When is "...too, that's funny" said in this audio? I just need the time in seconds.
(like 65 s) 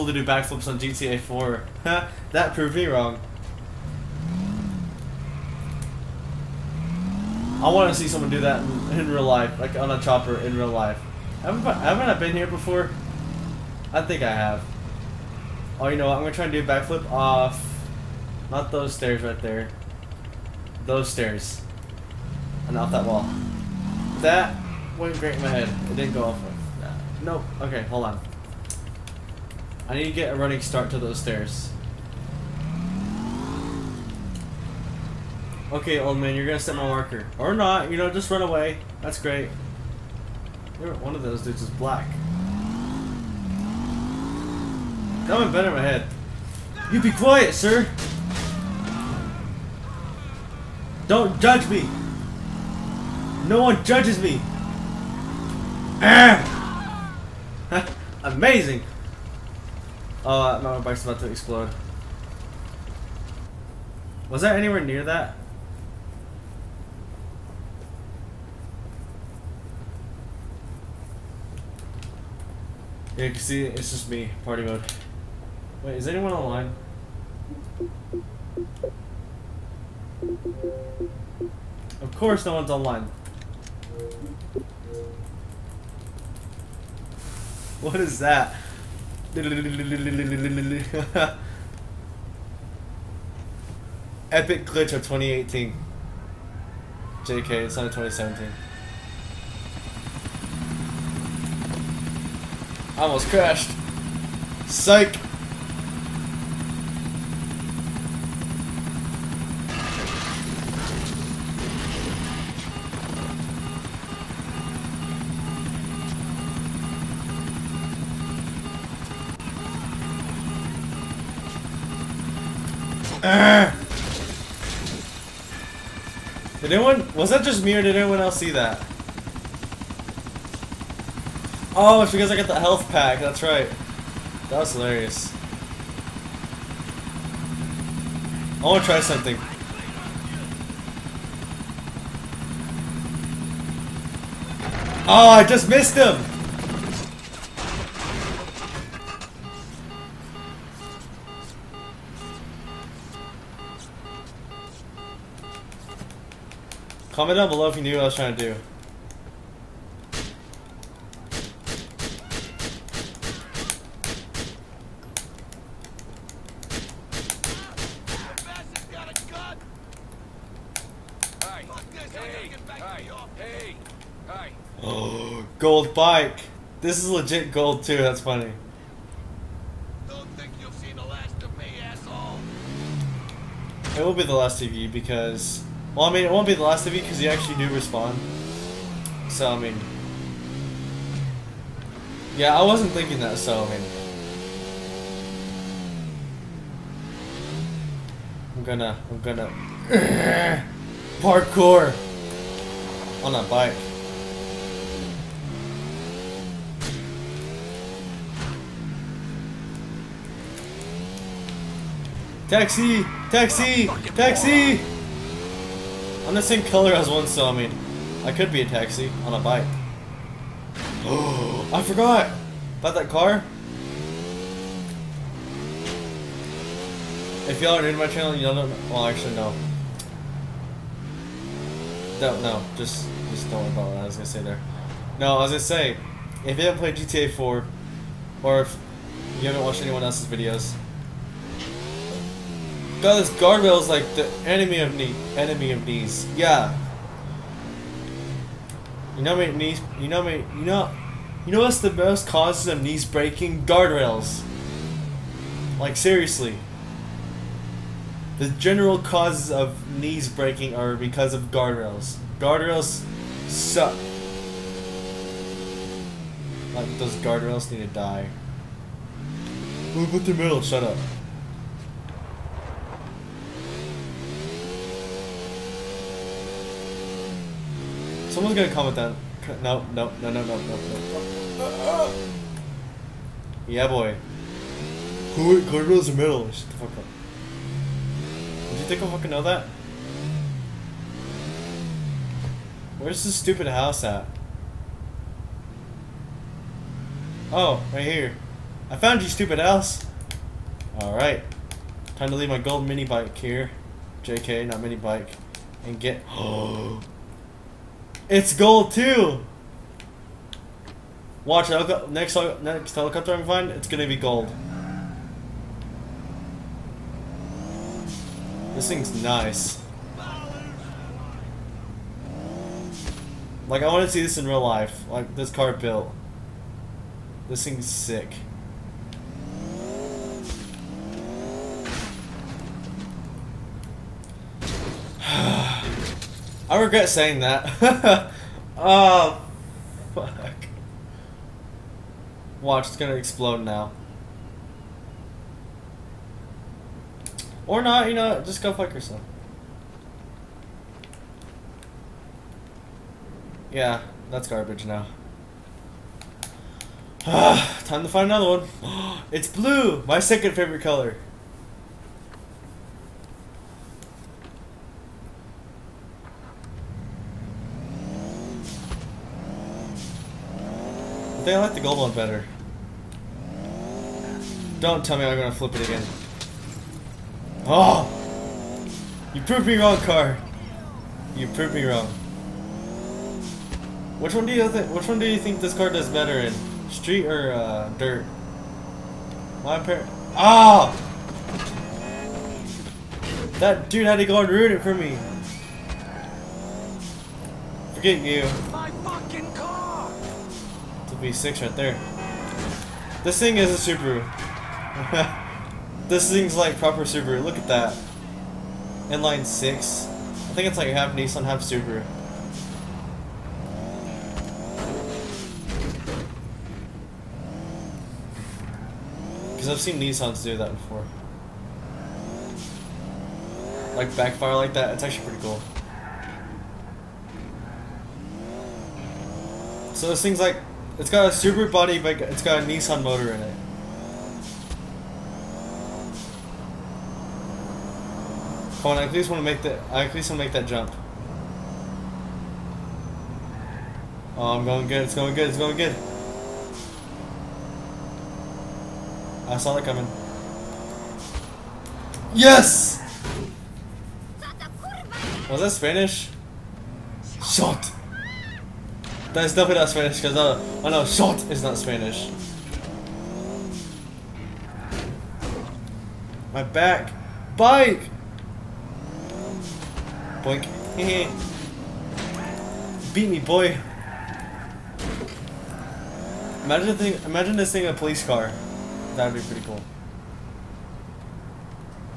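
177 s.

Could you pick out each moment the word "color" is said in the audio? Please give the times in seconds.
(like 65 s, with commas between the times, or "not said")
216 s, 360 s.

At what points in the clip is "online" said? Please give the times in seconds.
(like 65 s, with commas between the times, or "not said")
76 s, 82 s.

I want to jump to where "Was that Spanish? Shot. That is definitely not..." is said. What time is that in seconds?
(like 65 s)
455 s.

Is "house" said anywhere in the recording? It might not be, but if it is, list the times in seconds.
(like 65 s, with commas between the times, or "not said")
293 s, 299 s.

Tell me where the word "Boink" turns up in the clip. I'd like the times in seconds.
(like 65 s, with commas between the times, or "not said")
470 s.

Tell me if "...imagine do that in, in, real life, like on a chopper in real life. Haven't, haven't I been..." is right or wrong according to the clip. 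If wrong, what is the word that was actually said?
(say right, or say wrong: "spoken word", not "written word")
wrong: "someone", not "imagine".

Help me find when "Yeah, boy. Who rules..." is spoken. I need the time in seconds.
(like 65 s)
283 s.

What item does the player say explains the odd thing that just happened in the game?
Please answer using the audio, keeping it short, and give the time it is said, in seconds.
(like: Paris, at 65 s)
health pack, at 132 s.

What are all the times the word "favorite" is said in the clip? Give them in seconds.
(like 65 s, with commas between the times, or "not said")
360 s.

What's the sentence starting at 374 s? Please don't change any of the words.
Don't tell me I'm gonna flip it again.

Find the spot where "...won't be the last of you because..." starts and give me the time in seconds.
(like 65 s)
186 s.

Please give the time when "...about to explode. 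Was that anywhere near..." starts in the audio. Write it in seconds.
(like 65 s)
61 s.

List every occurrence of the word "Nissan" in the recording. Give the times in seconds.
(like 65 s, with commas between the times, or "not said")
411 s, 420 s, 432 s.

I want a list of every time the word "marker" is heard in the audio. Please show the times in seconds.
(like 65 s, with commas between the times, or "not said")
36 s.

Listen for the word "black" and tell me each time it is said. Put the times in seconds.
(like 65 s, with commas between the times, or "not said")
41 s.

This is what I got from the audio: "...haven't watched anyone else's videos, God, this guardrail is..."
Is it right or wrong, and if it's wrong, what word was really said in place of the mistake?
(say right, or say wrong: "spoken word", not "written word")
right.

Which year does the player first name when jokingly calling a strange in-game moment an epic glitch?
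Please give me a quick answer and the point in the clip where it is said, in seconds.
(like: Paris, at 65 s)
2018, at 95 s.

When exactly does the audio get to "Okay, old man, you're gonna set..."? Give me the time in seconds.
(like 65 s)
35 s.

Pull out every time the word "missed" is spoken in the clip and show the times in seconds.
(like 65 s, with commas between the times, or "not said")
145 s.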